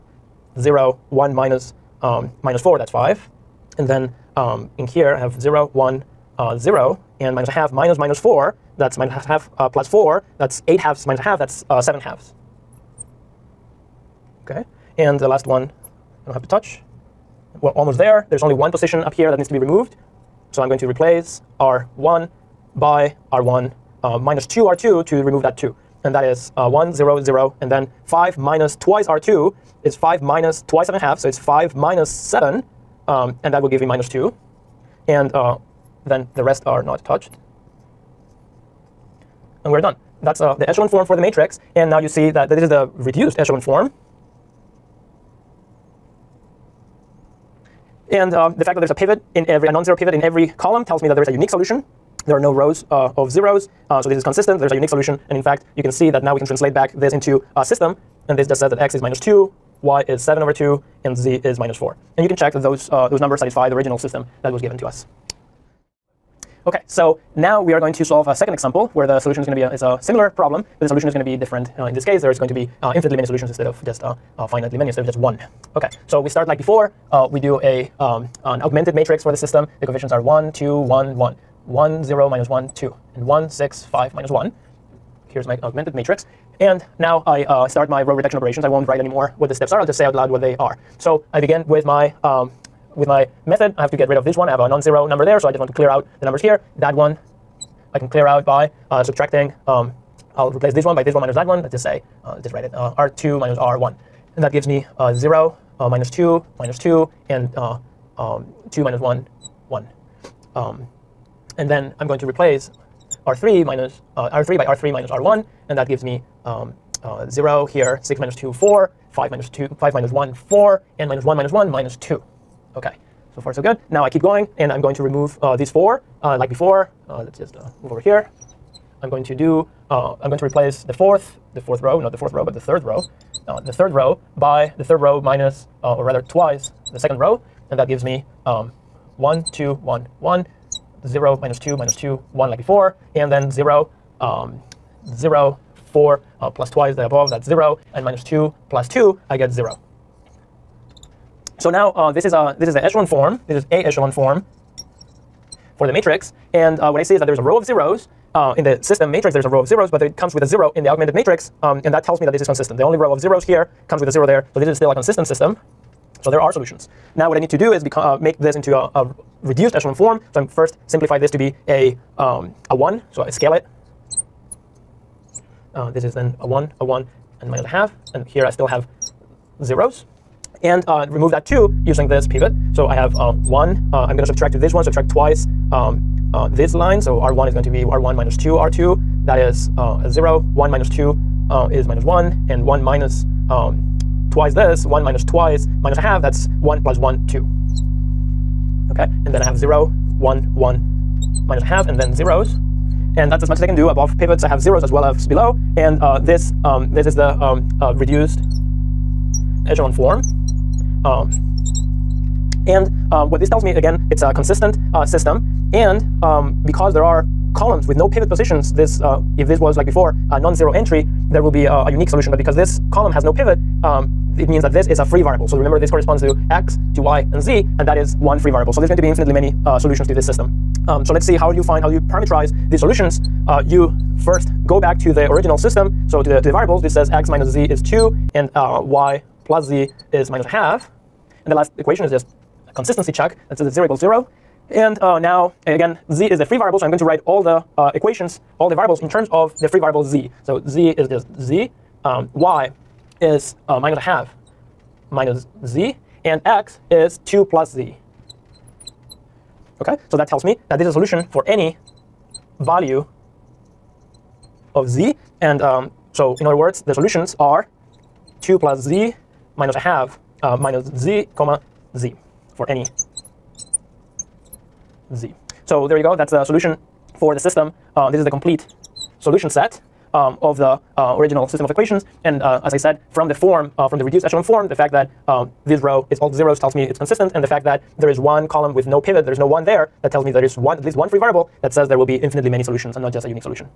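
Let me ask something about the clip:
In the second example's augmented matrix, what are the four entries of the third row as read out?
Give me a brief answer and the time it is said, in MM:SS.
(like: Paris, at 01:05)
1, 6, 5, -1, at 01:23.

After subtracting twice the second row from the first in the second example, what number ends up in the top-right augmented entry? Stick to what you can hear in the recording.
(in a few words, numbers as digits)
2.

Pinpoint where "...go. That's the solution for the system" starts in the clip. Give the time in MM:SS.
04:36.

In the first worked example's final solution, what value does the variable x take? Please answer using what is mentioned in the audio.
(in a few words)
-2.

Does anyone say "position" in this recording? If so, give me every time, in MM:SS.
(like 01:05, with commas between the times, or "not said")
00:18, 03:38.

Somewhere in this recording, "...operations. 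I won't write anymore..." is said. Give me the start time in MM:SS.
01:28.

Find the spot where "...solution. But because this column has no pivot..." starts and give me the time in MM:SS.
03:42.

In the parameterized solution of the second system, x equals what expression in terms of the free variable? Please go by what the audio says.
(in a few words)
2 + z.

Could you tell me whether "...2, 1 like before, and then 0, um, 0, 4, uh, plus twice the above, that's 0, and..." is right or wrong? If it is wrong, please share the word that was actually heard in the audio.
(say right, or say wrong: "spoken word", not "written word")
right.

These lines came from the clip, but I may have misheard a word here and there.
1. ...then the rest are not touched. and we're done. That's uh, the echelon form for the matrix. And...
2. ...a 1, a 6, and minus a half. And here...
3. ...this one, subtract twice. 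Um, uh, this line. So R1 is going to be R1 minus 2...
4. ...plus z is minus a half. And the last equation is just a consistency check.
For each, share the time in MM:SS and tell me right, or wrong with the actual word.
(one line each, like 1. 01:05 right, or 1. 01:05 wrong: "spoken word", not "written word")
1. 00:36 right
2. 02:56 wrong: "1", not "6"
3. 03:04 right
4. 03:59 right.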